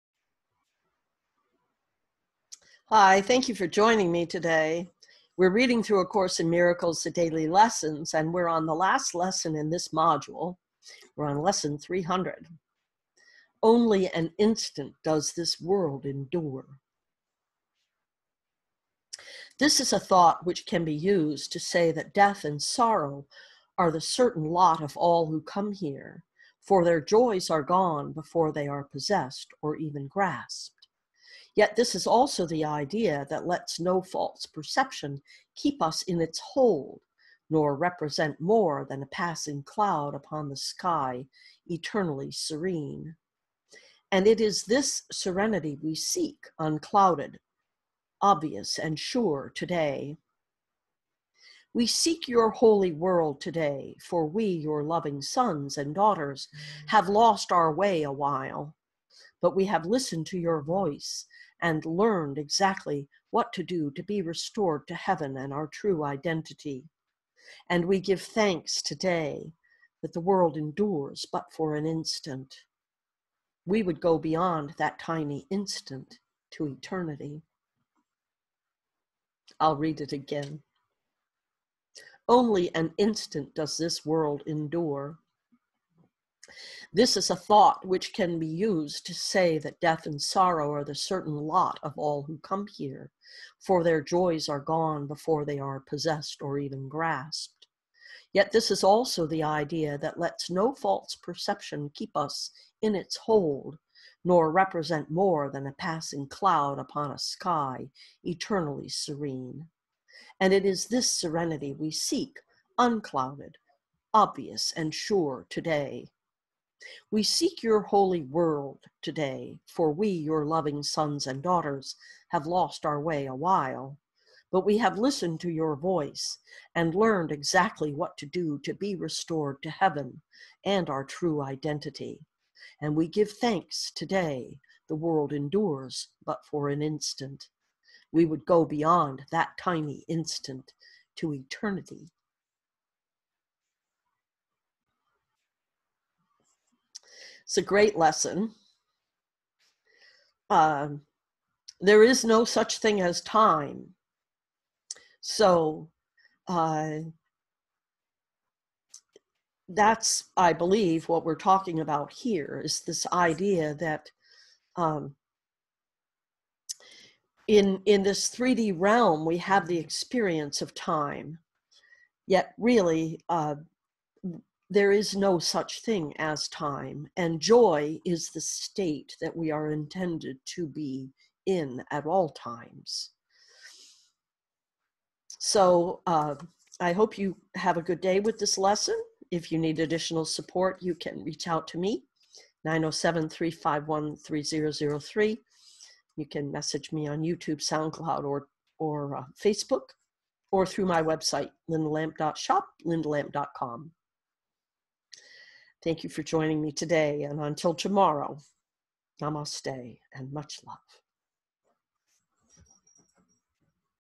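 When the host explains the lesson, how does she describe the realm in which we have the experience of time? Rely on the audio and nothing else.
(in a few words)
3D.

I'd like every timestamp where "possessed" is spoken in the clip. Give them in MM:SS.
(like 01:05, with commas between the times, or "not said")
00:28, 01:35.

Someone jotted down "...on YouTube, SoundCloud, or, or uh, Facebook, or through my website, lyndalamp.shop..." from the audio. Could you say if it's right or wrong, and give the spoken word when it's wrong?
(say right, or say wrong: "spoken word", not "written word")
right.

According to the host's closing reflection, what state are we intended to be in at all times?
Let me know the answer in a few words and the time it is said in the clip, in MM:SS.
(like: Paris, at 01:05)
Joy, at 02:57.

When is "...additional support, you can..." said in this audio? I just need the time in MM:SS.
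03:09.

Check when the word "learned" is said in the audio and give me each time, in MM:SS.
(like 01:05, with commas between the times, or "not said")
01:01, 02:06.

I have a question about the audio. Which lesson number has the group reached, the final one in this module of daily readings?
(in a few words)
300.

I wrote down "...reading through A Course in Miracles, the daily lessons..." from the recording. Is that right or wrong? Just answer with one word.
right.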